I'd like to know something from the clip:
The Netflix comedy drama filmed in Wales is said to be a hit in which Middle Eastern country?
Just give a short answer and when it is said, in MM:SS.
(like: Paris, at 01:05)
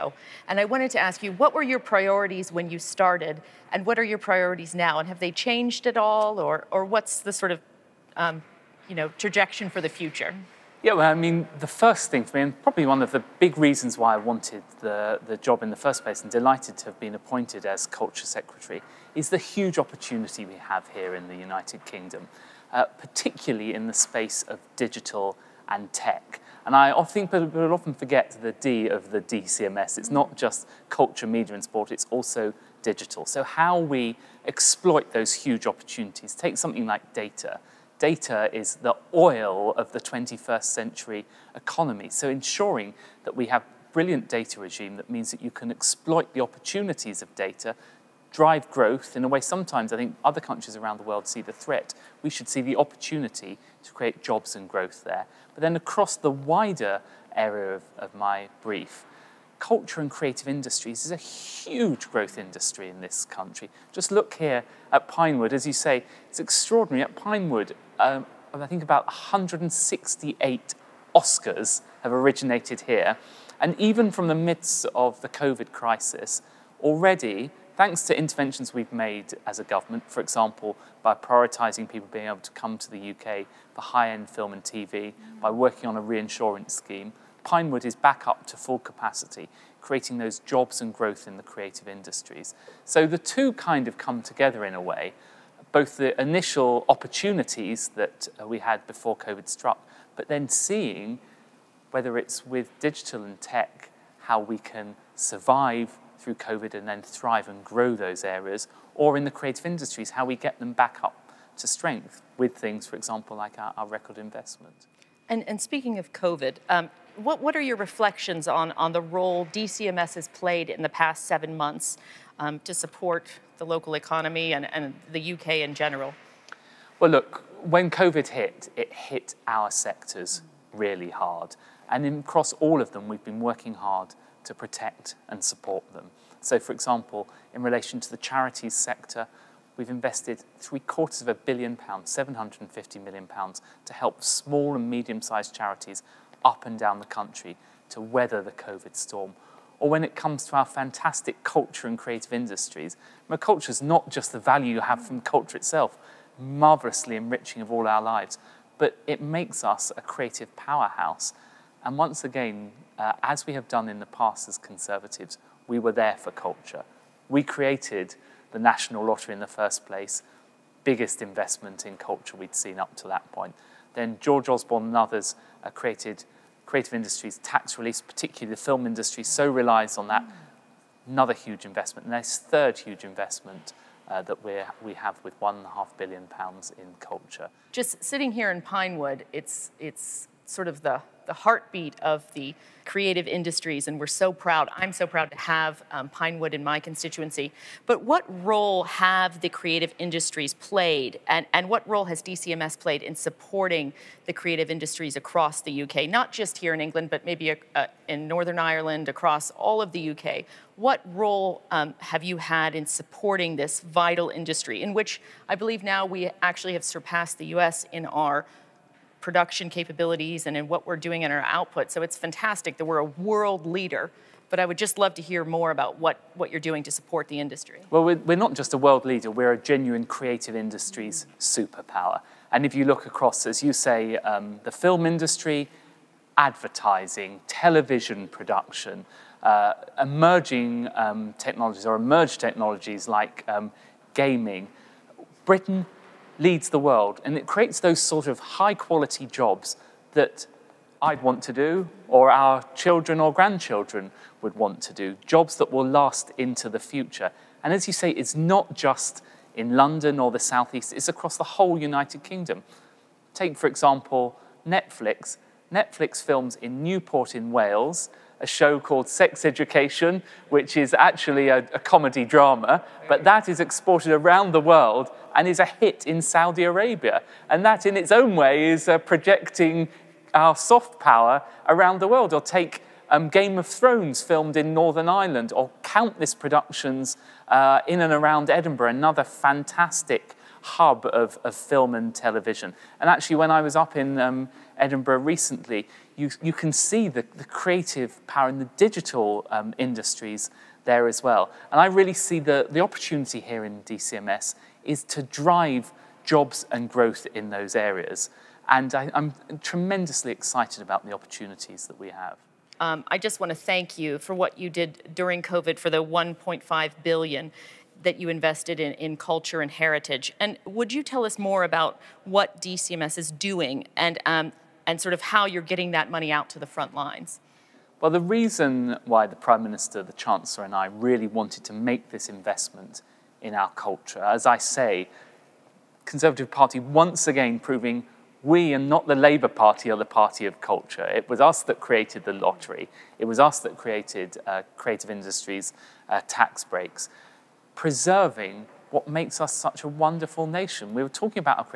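Saudi Arabia, at 04:36.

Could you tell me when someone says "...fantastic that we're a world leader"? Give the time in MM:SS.
03:42.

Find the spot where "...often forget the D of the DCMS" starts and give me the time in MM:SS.
00:27.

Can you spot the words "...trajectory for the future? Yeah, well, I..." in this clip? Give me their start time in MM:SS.
00:09.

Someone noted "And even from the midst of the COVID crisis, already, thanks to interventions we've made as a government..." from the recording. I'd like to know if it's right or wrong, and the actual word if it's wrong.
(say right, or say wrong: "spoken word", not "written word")
right.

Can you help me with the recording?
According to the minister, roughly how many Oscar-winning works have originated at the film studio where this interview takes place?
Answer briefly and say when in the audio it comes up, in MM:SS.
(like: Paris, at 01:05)
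168, at 01:09.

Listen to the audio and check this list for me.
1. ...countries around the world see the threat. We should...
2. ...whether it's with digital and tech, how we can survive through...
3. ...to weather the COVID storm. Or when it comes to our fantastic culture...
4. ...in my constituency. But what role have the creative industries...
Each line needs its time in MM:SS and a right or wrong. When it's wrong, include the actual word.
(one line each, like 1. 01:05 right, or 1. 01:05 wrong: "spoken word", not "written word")
1. 00:50 right
2. 01:41 right
3. 02:27 right
4. 03:16 right.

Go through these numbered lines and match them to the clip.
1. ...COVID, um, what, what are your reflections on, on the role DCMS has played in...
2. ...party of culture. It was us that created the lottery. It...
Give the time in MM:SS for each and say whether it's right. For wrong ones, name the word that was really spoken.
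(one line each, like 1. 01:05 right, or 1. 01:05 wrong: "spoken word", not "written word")
1. 01:56 right
2. 05:40 right.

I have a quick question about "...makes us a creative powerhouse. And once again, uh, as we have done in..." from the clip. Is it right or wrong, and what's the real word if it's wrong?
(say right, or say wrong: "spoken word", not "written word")
right.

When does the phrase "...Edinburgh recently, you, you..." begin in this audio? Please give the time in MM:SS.
04:54.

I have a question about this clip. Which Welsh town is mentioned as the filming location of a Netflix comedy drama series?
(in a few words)
Newport.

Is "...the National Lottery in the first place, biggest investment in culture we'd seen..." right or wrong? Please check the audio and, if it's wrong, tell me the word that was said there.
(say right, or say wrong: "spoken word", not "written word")
right.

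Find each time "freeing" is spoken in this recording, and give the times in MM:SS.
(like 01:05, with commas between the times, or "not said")
not said.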